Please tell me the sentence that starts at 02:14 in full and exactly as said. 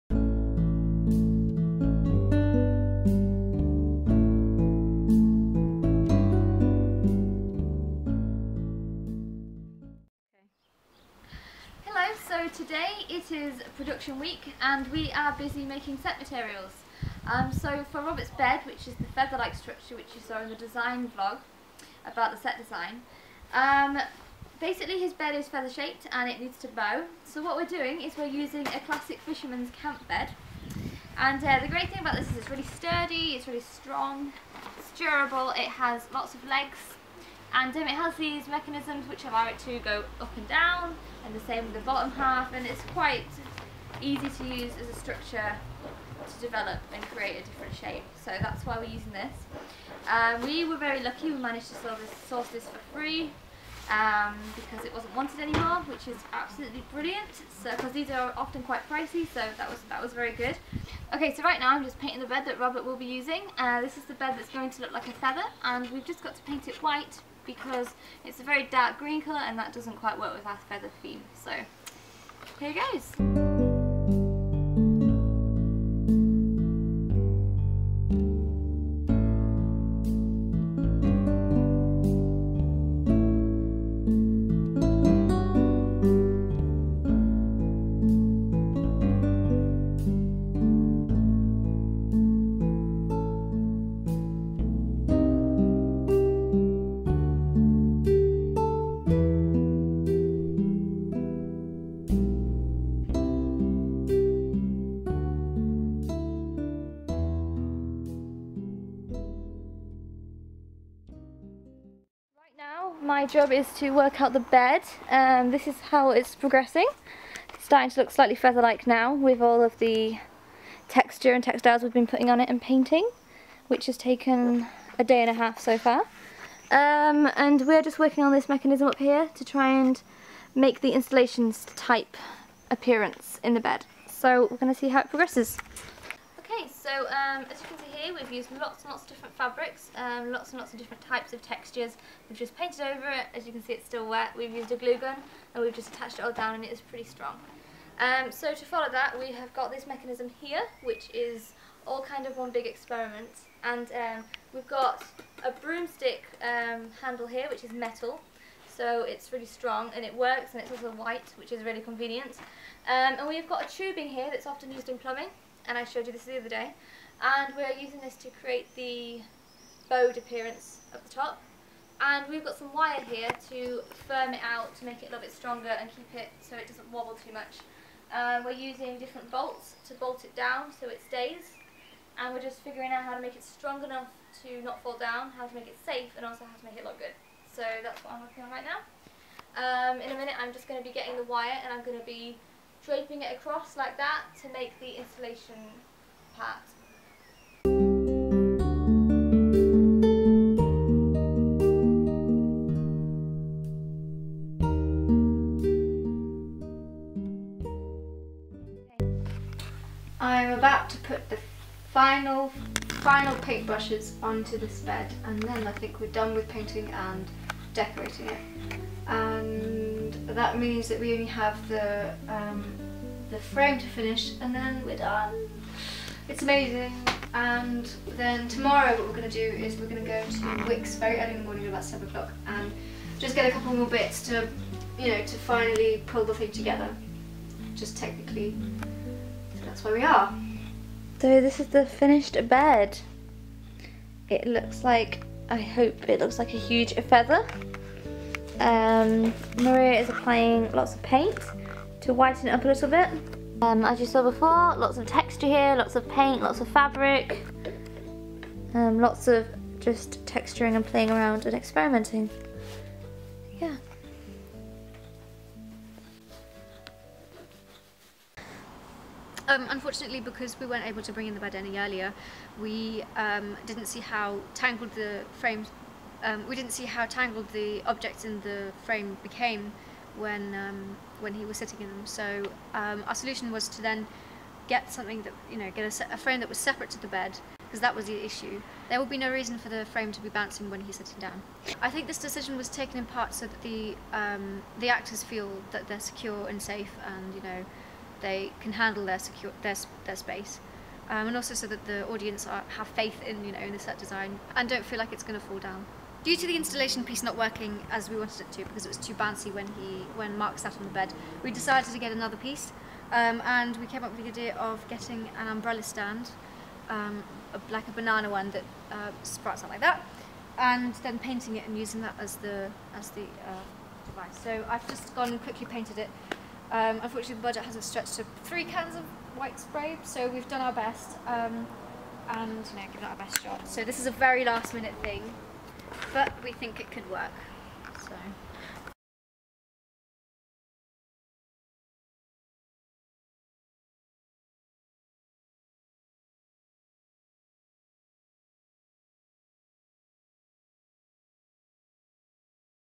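So we're going to see how it progresses.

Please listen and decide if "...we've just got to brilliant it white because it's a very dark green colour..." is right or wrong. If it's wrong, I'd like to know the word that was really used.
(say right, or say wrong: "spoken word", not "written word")
wrong: "paint", not "brilliant".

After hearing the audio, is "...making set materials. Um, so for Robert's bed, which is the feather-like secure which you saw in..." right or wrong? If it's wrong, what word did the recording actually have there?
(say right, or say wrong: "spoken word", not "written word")
wrong: "structure", not "secure".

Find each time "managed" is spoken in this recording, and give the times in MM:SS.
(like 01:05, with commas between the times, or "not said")
00:51.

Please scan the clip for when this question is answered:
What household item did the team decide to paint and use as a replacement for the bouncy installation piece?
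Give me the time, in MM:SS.
05:15.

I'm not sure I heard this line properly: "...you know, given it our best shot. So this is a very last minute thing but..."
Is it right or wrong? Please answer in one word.
right.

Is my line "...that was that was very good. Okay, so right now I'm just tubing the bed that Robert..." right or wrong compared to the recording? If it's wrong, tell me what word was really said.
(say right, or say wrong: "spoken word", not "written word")
wrong: "painting", not "tubing".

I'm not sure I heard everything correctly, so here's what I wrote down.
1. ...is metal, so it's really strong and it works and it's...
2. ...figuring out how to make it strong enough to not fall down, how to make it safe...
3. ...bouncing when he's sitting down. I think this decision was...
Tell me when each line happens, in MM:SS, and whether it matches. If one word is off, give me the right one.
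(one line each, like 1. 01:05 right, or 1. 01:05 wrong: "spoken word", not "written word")
1. 02:37 right
2. 03:02 right
3. 04:50 right.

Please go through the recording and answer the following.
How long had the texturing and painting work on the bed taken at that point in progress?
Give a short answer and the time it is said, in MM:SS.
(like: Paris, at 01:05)
A day and a half, at 02:04.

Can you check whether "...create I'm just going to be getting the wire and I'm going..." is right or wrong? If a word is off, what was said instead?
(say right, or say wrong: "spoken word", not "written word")
wrong: "minute", not "create".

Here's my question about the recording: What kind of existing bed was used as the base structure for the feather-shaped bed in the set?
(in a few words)
Fisherman's camp bed.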